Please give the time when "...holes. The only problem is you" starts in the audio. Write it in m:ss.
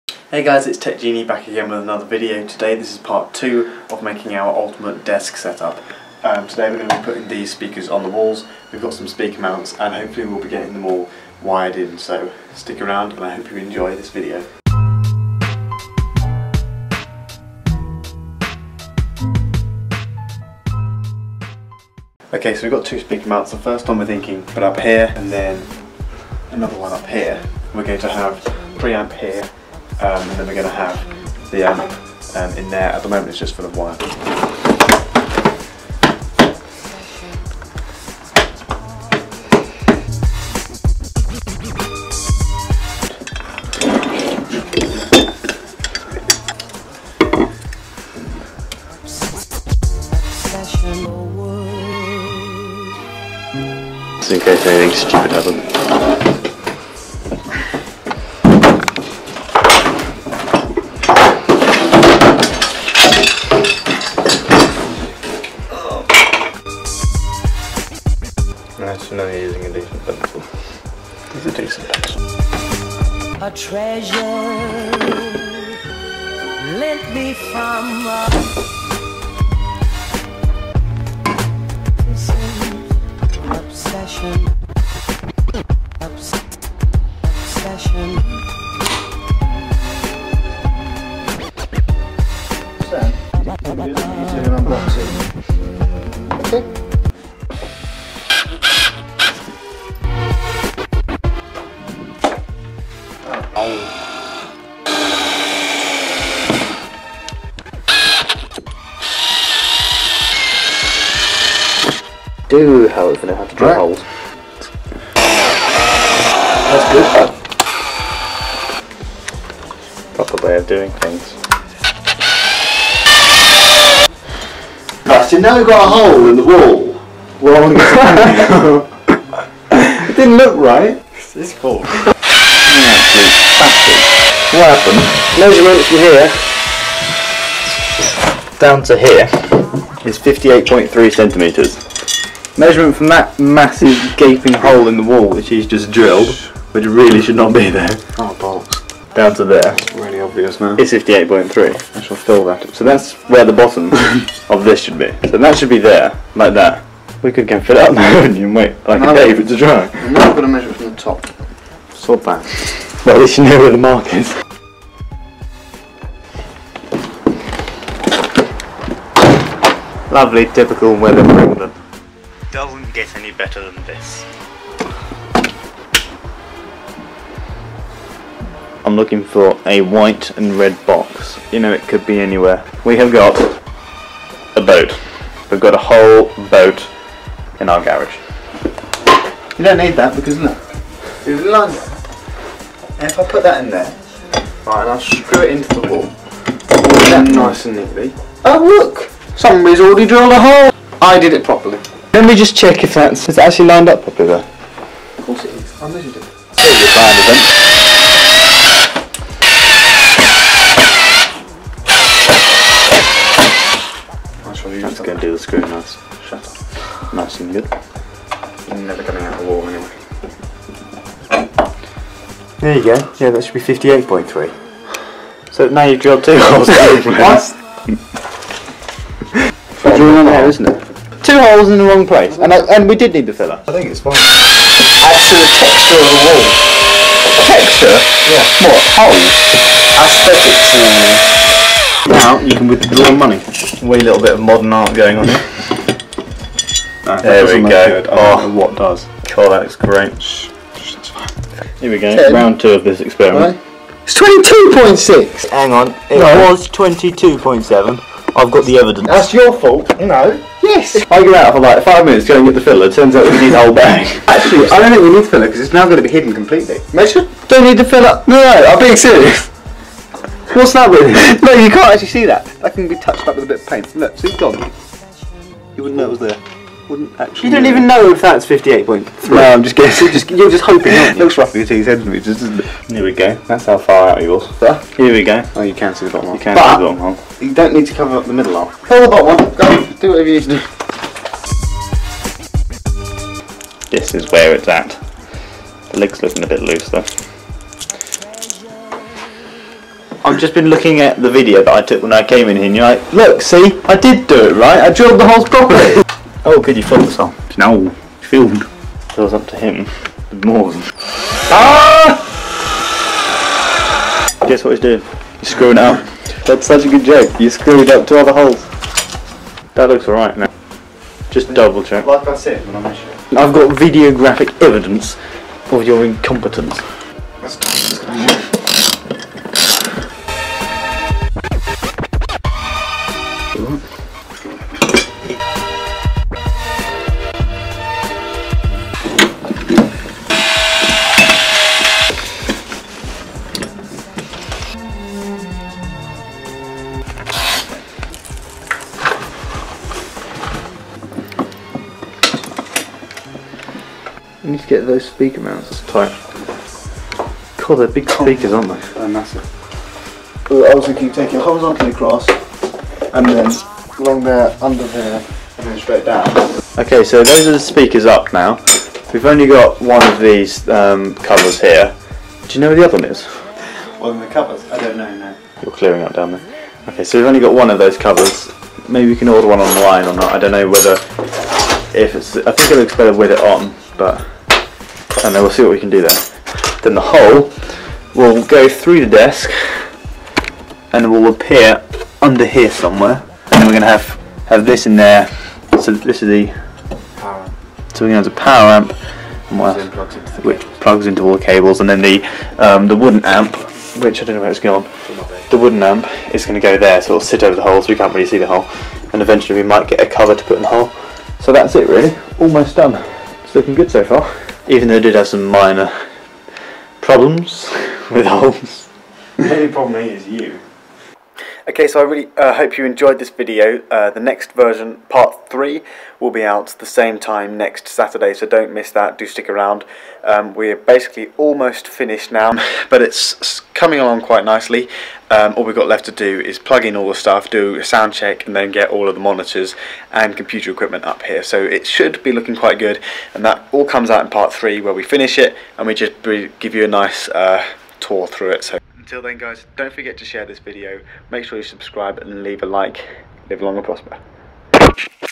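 6:58.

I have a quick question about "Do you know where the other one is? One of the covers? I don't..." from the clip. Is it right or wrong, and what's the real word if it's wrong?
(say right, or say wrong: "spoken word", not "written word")
right.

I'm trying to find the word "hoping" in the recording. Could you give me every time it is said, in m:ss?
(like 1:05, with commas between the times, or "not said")
4:40.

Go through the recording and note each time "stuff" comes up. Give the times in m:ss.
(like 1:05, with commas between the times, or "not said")
7:17.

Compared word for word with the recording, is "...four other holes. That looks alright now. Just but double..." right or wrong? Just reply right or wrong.
wrong.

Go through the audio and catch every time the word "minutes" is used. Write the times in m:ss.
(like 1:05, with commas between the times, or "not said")
4:22.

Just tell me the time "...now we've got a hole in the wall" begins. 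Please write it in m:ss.
2:05.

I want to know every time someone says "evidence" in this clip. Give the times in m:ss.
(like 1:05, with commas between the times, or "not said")
4:18, 5:24.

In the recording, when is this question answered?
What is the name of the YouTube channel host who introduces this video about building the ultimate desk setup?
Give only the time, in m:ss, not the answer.
0:00.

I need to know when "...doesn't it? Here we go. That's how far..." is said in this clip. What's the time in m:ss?
4:42.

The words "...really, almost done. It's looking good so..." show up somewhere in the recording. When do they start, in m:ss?
6:51.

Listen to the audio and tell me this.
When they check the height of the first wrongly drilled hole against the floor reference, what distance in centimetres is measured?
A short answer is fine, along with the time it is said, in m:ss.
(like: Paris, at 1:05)
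58.3, at 2:20.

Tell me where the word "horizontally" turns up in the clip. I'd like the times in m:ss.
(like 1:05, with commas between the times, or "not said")
6:01.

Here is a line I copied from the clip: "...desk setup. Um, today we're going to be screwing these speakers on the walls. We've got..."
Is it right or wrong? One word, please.
wrong.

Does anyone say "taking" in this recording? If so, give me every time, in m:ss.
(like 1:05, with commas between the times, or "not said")
6:01.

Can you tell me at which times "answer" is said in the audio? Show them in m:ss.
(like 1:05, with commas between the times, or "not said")
not said.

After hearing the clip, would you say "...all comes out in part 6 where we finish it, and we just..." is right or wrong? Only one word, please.
wrong.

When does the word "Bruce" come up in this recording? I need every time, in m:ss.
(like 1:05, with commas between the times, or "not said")
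not said.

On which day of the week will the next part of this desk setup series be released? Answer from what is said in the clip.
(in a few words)
Saturday.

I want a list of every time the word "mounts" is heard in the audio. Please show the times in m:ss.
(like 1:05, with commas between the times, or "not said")
0:09, 0:23, 5:55.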